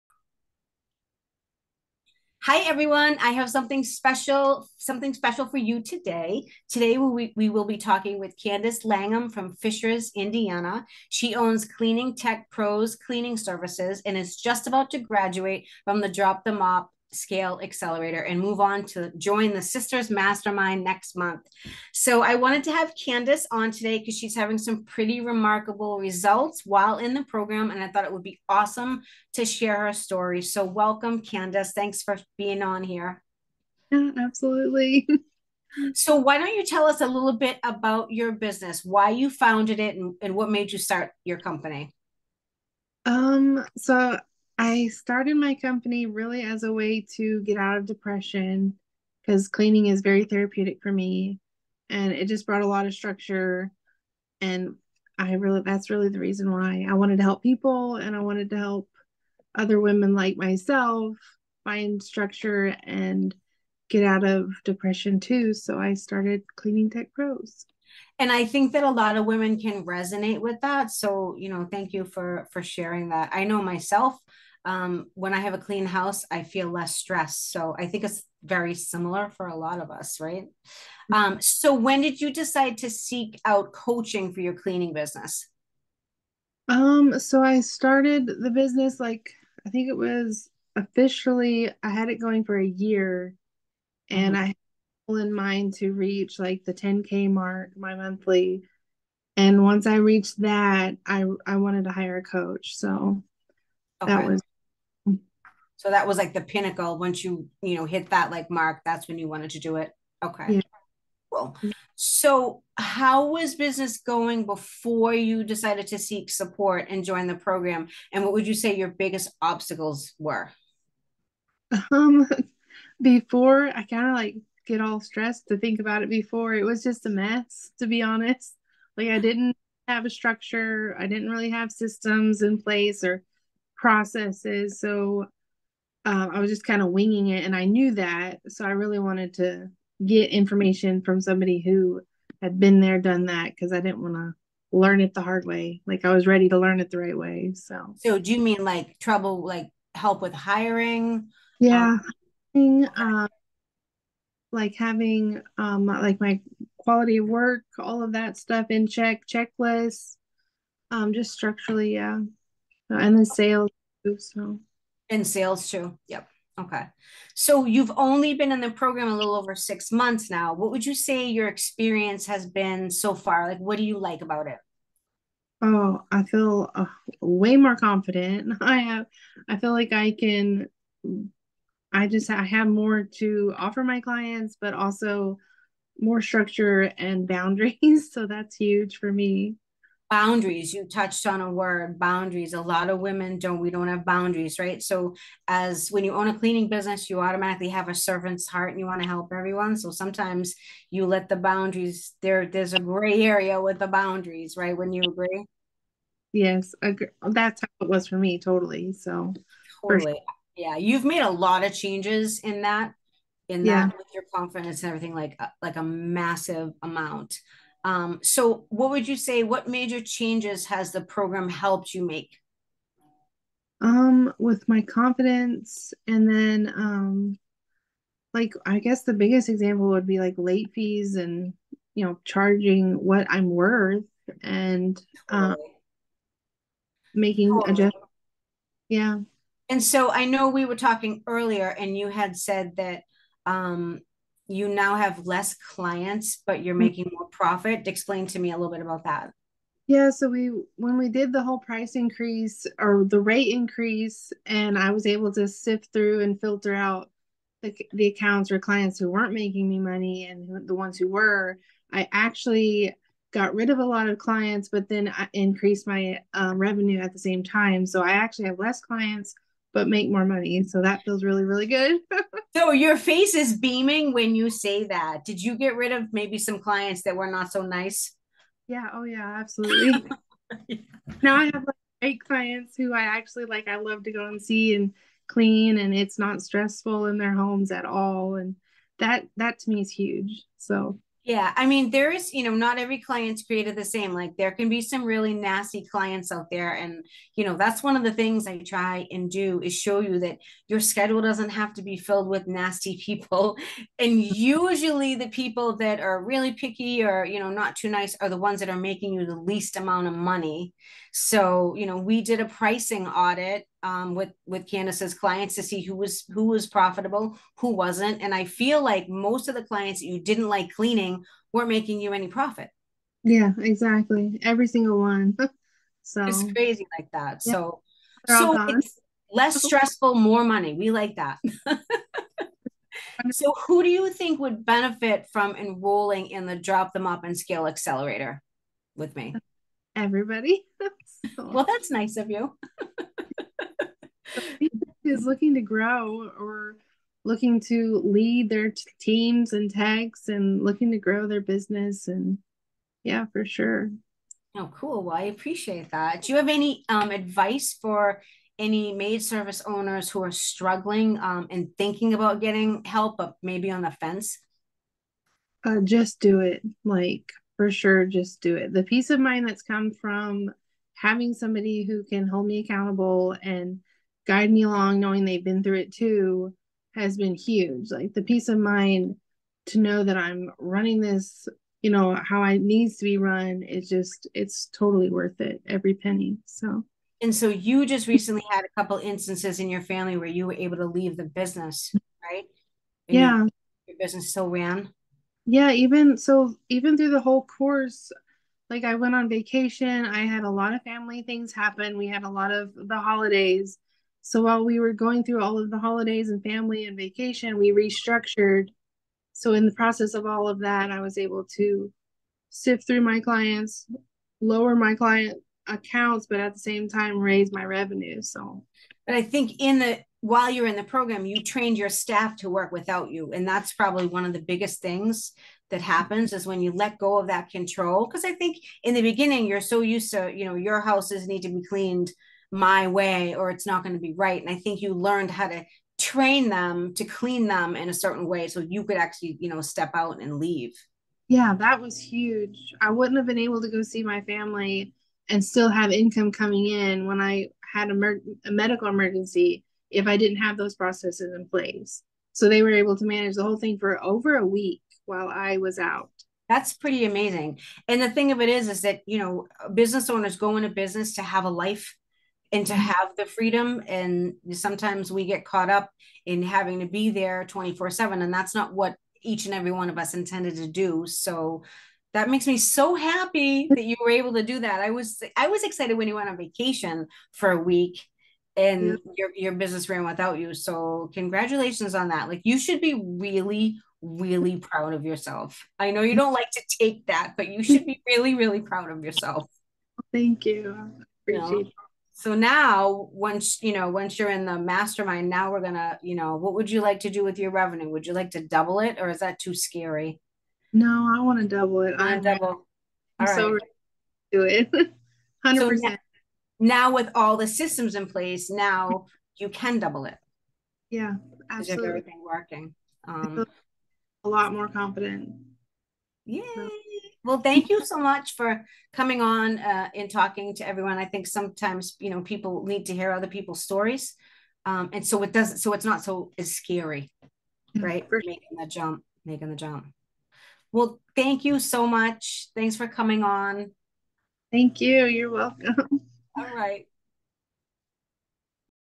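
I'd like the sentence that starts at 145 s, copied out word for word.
Like I was ready to learn it the right way.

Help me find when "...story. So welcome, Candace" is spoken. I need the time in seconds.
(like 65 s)
29 s.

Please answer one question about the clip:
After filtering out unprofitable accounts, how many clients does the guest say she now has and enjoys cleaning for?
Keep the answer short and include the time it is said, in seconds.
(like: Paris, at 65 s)
8, at 282 s.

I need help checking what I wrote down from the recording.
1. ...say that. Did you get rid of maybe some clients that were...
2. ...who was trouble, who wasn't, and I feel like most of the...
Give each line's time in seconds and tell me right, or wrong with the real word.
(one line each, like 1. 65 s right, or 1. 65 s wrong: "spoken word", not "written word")
1. 274 s right
2. 316 s wrong: "profitable", not "trouble".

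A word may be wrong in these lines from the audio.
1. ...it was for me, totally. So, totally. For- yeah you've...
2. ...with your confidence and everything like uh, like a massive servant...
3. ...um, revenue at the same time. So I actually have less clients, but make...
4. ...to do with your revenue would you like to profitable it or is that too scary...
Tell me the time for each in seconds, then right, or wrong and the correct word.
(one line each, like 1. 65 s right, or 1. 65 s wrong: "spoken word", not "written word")
1. 207 s right
2. 213 s wrong: "amount", not "servant"
3. 266 s right
4. 496 s wrong: "double", not "profitable".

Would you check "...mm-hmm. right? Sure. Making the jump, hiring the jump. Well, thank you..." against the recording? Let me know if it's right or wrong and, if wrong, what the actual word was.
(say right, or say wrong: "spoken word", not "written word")
wrong: "making", not "hiring".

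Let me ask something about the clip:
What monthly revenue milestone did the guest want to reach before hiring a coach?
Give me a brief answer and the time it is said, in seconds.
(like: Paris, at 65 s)
10k, at 96 s.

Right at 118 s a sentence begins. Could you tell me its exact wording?
And what would you say your biggest obstacles were?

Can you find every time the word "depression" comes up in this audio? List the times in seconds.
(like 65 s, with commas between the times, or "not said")
47 s, 64 s.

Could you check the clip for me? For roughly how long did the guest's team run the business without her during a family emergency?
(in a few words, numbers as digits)
over a week.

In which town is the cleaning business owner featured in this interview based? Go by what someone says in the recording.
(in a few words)
Fishers, Indiana.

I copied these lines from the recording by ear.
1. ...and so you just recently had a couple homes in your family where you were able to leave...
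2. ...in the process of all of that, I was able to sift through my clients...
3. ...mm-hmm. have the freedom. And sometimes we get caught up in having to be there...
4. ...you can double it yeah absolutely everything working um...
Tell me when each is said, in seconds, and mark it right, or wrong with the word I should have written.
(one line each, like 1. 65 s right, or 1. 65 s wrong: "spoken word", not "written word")
1. 387 s wrong: "instances", not "homes"
2. 409 s right
3. 462 s right
4. 509 s right.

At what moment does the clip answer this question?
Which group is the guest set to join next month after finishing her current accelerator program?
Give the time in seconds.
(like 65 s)
19 s.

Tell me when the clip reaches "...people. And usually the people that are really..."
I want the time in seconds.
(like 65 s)
303 s.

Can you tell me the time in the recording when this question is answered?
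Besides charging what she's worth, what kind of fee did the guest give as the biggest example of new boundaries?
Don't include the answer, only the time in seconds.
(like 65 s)
230 s.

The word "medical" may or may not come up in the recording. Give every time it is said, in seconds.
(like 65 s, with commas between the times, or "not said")
448 s.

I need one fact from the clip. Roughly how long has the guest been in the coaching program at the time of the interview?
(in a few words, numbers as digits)
a little over six months.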